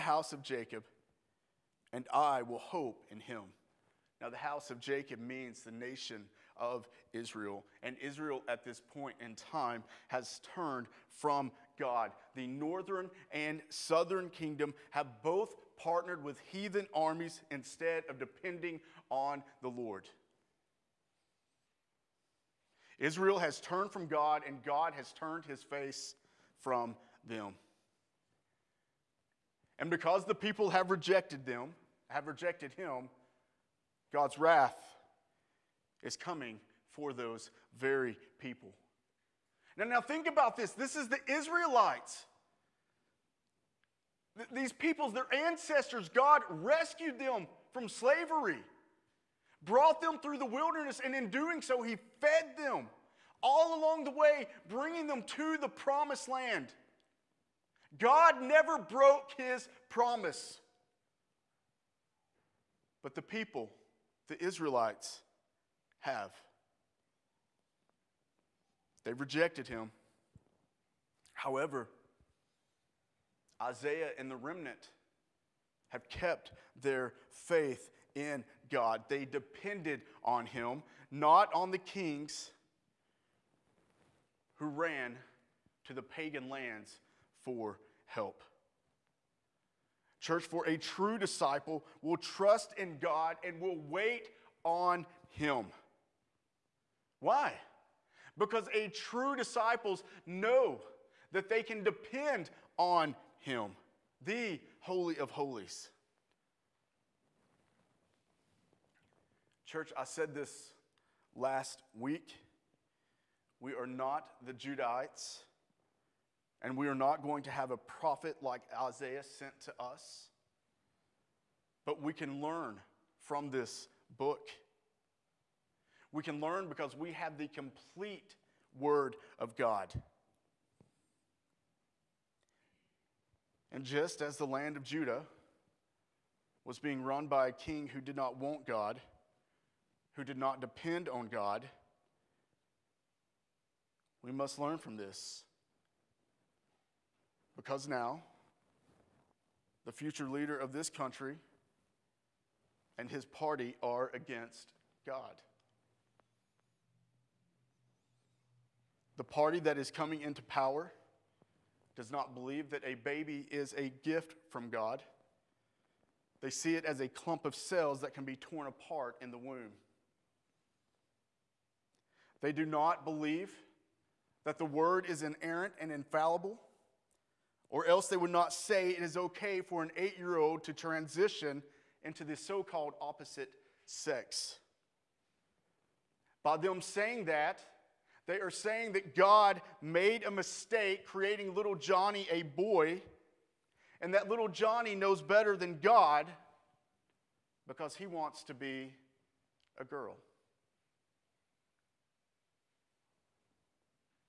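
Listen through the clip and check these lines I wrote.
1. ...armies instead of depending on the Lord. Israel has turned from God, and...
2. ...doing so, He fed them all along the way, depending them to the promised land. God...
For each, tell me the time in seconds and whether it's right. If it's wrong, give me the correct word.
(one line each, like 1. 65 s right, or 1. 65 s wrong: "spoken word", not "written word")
1. 16 s right
2. 51 s wrong: "bringing", not "depending".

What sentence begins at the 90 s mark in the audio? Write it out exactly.
Church, for a true disciple will trust in God and will wait on him.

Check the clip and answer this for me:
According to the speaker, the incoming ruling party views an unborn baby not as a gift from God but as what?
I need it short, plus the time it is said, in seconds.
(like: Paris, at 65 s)
a clump of cells, at 167 s.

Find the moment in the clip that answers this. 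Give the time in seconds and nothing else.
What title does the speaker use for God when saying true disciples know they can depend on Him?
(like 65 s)
104 s.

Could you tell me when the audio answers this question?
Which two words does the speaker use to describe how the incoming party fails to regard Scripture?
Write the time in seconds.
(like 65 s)
175 s.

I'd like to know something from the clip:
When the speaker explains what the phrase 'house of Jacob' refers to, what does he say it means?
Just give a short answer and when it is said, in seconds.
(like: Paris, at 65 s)
the nation of Israel, at 5 s.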